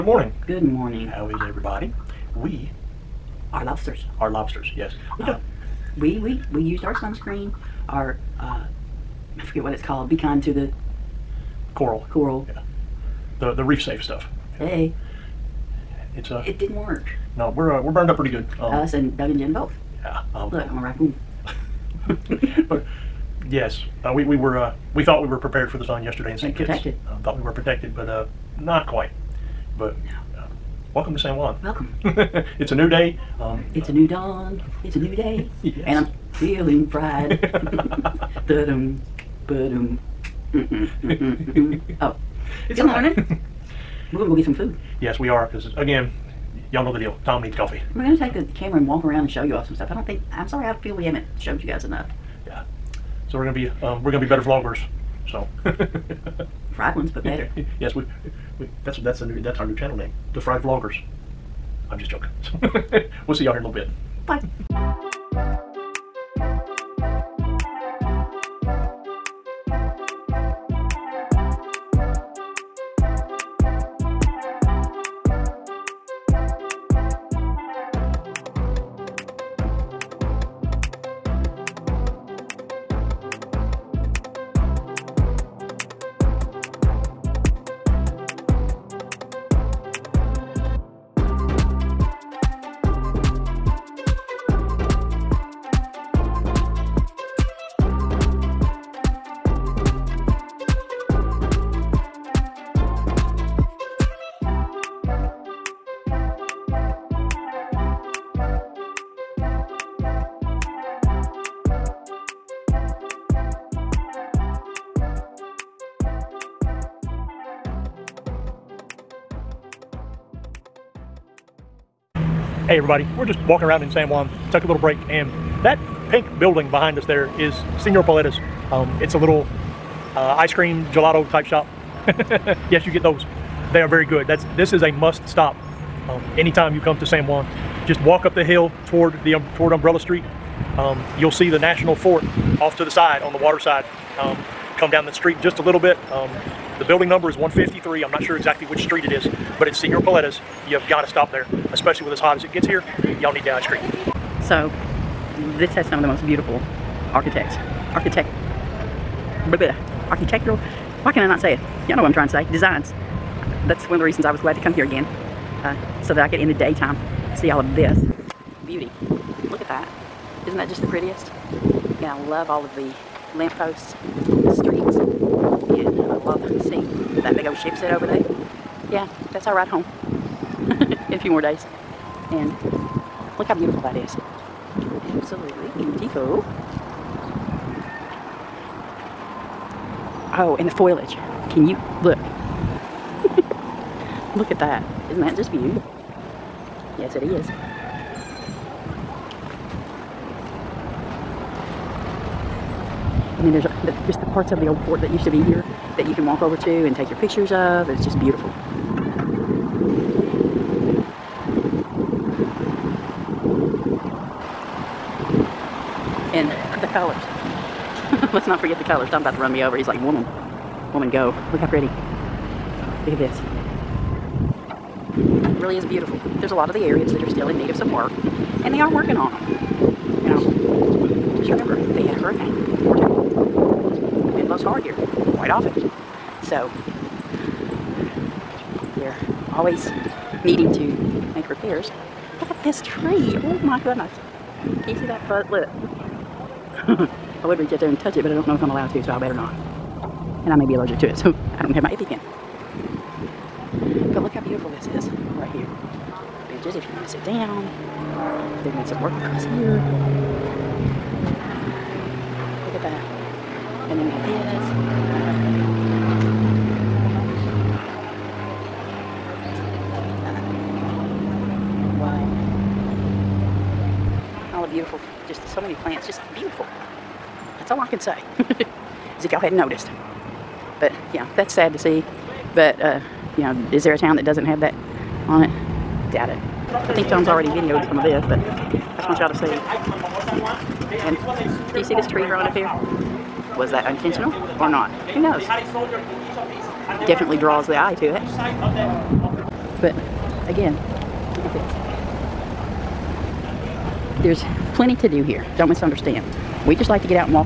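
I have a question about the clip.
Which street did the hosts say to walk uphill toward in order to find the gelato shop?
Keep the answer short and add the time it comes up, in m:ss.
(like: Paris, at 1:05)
Umbrella Street, at 2:19.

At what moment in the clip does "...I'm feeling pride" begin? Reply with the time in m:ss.
0:36.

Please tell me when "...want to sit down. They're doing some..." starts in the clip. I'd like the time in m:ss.
4:16.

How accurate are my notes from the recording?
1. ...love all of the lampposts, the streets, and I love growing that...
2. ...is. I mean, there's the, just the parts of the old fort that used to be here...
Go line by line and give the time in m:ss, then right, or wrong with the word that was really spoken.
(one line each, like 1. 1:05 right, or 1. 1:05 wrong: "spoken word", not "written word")
1. 2:52 wrong: "seeing", not "growing"
2. 3:17 right.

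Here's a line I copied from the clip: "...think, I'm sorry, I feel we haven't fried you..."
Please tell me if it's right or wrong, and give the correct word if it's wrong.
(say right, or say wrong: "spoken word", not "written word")
wrong: "showed", not "fried".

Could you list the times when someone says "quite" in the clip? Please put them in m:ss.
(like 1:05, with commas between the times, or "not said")
0:28, 3:55.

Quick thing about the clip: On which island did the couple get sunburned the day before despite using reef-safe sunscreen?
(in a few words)
St. Kitts.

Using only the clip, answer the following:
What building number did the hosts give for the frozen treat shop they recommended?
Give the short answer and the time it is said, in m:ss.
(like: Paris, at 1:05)
153, at 2:27.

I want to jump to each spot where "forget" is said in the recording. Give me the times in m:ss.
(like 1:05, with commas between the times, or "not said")
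0:09, 3:38.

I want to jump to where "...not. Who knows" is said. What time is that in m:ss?
4:54.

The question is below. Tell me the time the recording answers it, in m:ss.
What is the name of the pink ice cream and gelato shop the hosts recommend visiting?
2:07.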